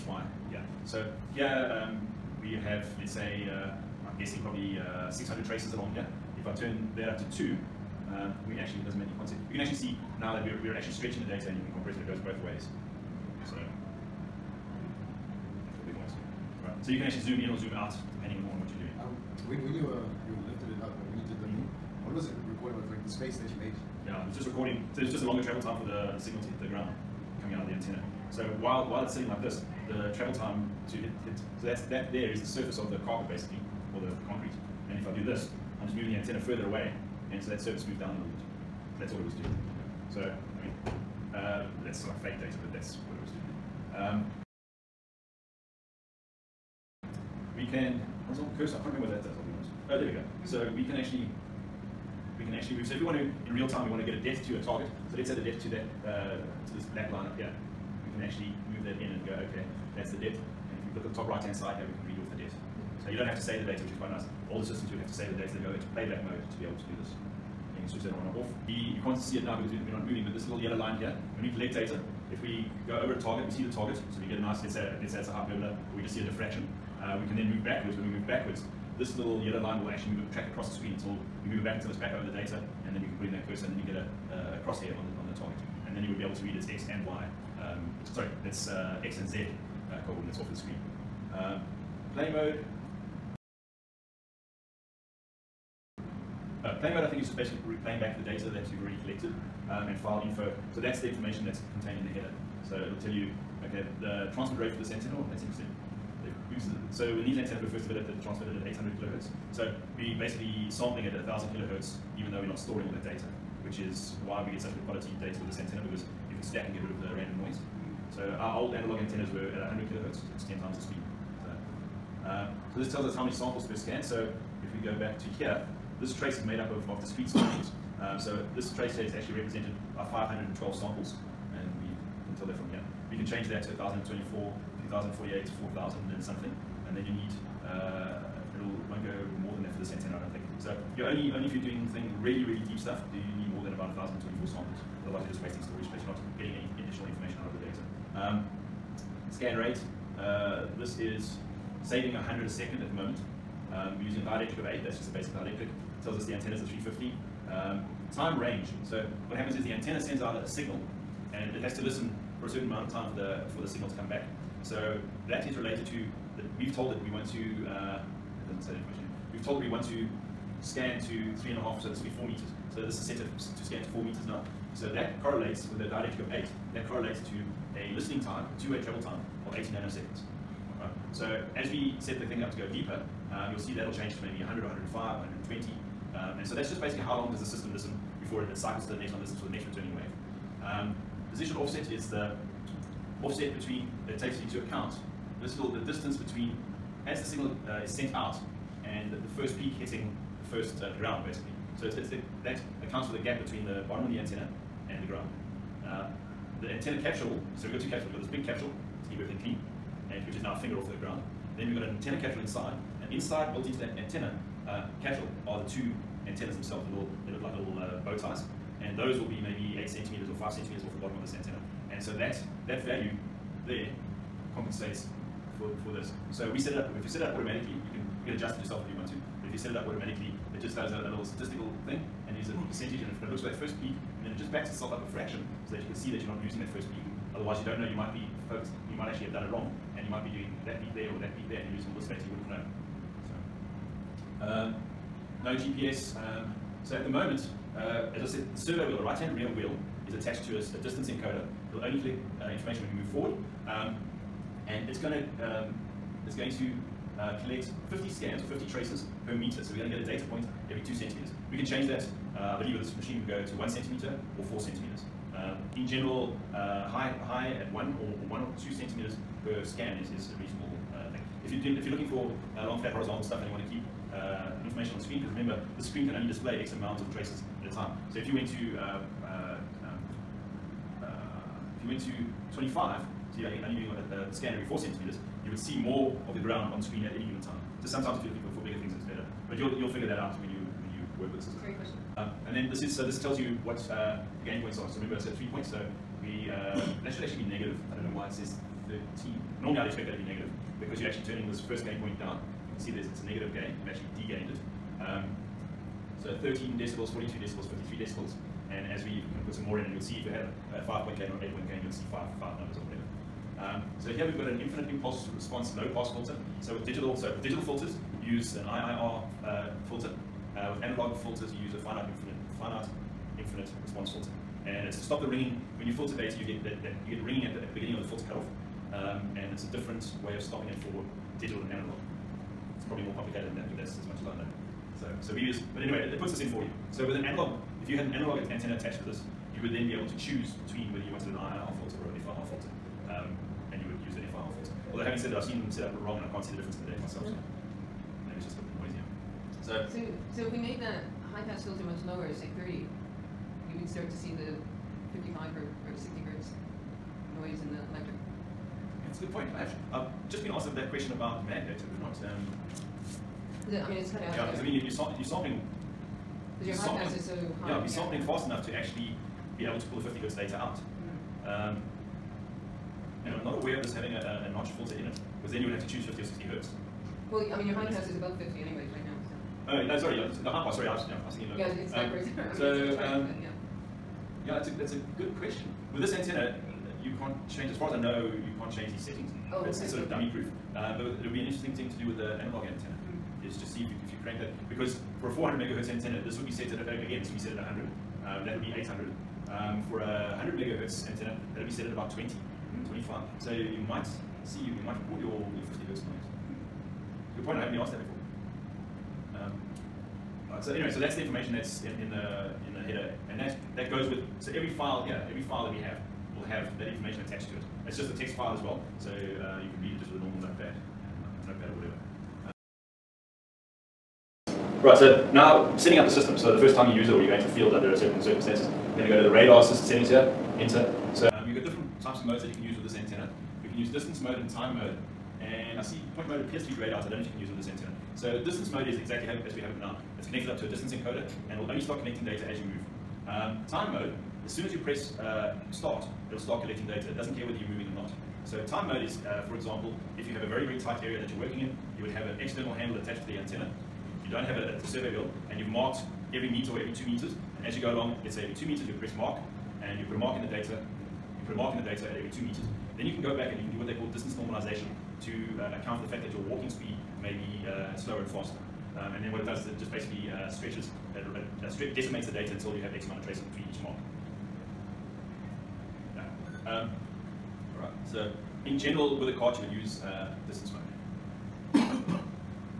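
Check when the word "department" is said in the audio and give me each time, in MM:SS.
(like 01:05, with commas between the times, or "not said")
not said.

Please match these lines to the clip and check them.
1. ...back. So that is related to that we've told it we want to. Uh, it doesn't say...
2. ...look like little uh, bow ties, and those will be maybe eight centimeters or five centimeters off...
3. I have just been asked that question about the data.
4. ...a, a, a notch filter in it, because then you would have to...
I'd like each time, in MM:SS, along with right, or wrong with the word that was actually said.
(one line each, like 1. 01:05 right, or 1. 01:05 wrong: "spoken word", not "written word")
1. 02:44 right
2. 03:37 right
3. 05:59 right
4. 06:14 right.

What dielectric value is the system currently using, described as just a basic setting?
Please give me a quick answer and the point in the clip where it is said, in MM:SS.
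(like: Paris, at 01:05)
8, at 02:34.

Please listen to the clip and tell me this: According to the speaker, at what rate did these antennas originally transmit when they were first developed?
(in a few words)
800 kilohertz.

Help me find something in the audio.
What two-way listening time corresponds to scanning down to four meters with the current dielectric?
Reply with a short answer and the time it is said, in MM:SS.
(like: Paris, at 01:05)
80 nanoseconds, at 02:59.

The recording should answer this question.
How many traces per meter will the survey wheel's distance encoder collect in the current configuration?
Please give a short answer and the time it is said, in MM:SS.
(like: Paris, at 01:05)
50, at 04:17.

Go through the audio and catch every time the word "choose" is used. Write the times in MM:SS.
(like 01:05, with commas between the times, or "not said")
05:40, 06:15.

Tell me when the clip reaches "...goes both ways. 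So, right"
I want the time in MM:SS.
00:12.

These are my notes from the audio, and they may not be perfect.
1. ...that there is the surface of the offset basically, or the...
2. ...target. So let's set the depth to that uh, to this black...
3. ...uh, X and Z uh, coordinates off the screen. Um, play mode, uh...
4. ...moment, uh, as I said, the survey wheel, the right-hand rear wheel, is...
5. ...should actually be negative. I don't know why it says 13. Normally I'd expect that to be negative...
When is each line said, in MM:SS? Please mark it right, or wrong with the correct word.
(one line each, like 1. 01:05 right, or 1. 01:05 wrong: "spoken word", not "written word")
1. 00:31 wrong: "carpet", not "offset"
2. 00:54 right
3. 01:28 right
4. 04:07 right
5. 04:57 right.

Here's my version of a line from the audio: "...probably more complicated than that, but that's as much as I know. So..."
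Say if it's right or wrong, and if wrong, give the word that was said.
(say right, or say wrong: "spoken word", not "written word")
right.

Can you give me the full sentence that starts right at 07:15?
And I see point mode appears to be grayed out.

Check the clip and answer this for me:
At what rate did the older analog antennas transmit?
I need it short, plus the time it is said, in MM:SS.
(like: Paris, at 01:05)
100 kilohertz, at 01:59.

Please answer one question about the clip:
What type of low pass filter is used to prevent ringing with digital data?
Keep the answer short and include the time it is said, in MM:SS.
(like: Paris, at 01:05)
infinite impulse response, at 05:14.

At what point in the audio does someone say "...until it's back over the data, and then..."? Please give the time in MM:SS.
01:21.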